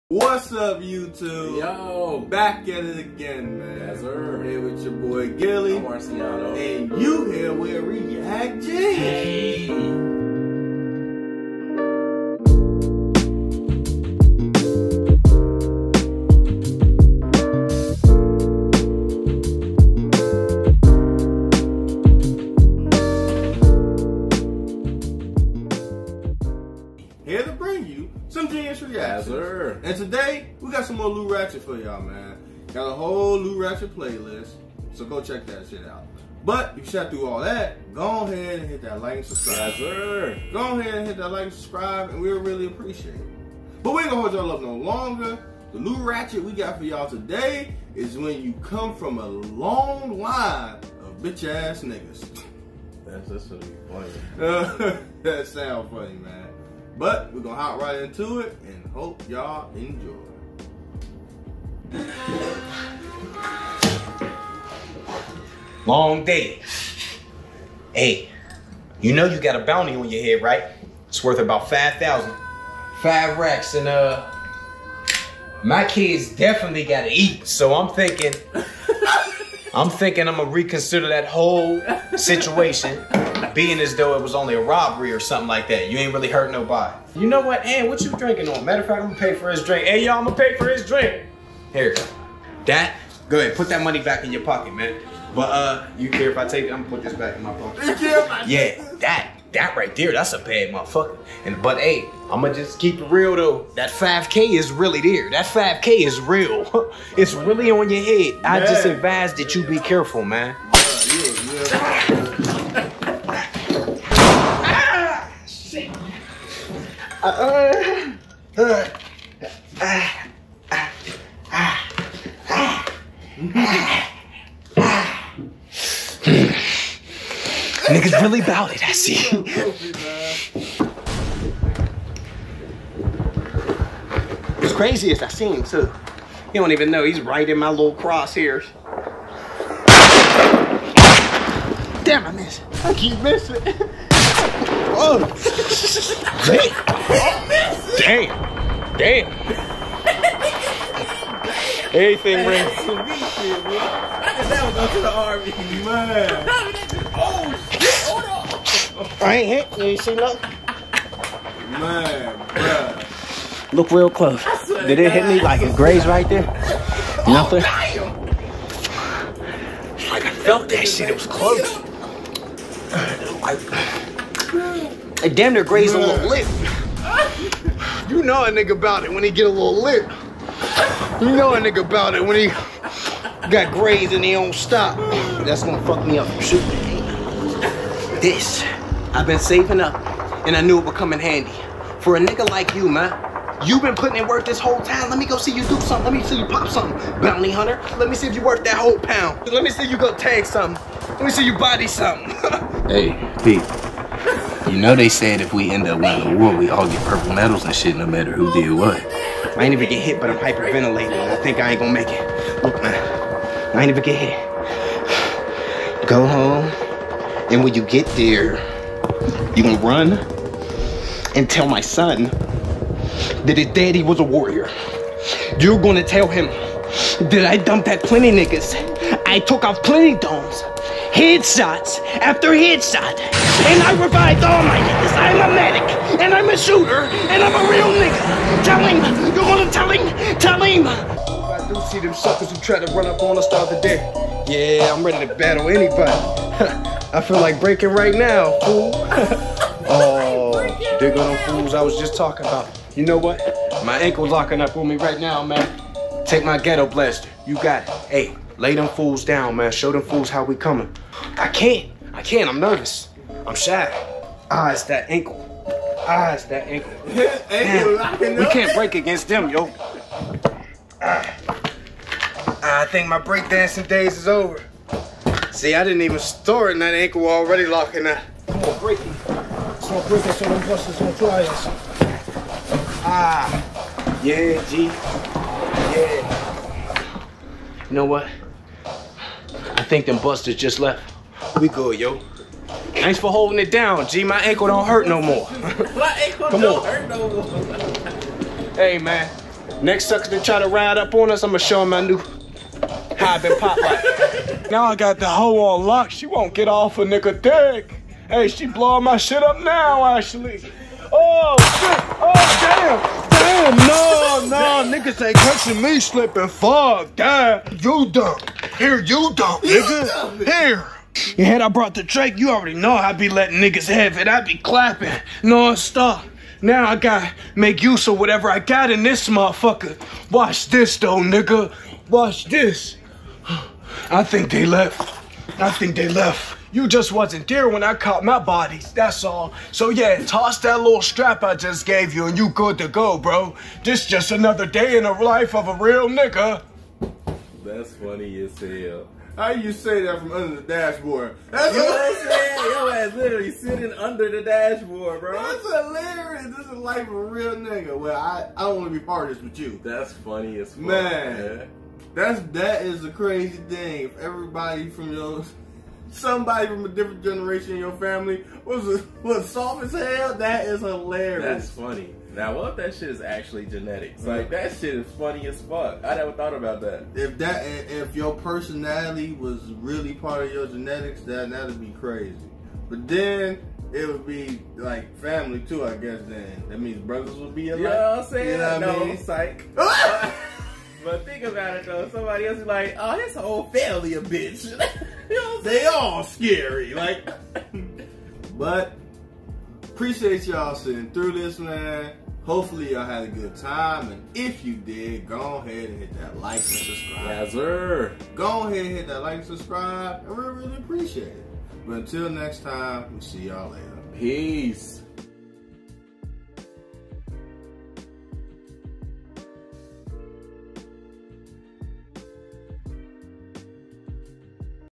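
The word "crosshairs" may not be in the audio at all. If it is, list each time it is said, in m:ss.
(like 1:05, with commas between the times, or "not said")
2:17.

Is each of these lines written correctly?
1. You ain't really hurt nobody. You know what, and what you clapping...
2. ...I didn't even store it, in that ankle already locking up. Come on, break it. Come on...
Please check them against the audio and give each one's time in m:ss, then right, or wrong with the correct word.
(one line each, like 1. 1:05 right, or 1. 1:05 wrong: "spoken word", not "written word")
1. 1:25 wrong: "drinking", not "clapping"
2. 4:35 right.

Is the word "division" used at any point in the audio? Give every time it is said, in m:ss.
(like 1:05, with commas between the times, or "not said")
not said.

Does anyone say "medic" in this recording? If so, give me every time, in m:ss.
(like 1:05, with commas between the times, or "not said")
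3:55.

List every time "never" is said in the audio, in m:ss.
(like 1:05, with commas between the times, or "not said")
6:16.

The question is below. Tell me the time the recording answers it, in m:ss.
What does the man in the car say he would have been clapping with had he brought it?
5:22.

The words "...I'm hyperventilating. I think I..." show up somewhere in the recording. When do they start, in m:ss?
3:30.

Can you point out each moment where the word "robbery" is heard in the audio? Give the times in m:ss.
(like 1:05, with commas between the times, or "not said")
1:24.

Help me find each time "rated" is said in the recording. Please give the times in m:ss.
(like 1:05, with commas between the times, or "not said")
not said.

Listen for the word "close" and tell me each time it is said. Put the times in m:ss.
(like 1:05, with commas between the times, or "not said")
2:44, 2:51.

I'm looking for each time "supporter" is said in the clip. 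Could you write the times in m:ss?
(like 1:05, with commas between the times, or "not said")
not said.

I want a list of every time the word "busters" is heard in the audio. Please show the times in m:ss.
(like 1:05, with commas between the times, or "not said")
4:40, 4:50.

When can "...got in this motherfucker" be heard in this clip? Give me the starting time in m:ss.
5:28.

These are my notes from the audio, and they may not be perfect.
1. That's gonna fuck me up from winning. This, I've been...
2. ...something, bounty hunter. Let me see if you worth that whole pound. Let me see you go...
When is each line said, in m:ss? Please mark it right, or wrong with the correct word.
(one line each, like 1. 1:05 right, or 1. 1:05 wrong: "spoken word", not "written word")
1. 3:05 wrong: "shooting", not "winning"
2. 3:16 right.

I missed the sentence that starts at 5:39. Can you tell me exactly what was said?
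So yeah, toss that little strap I just gave you and you good to go, bro.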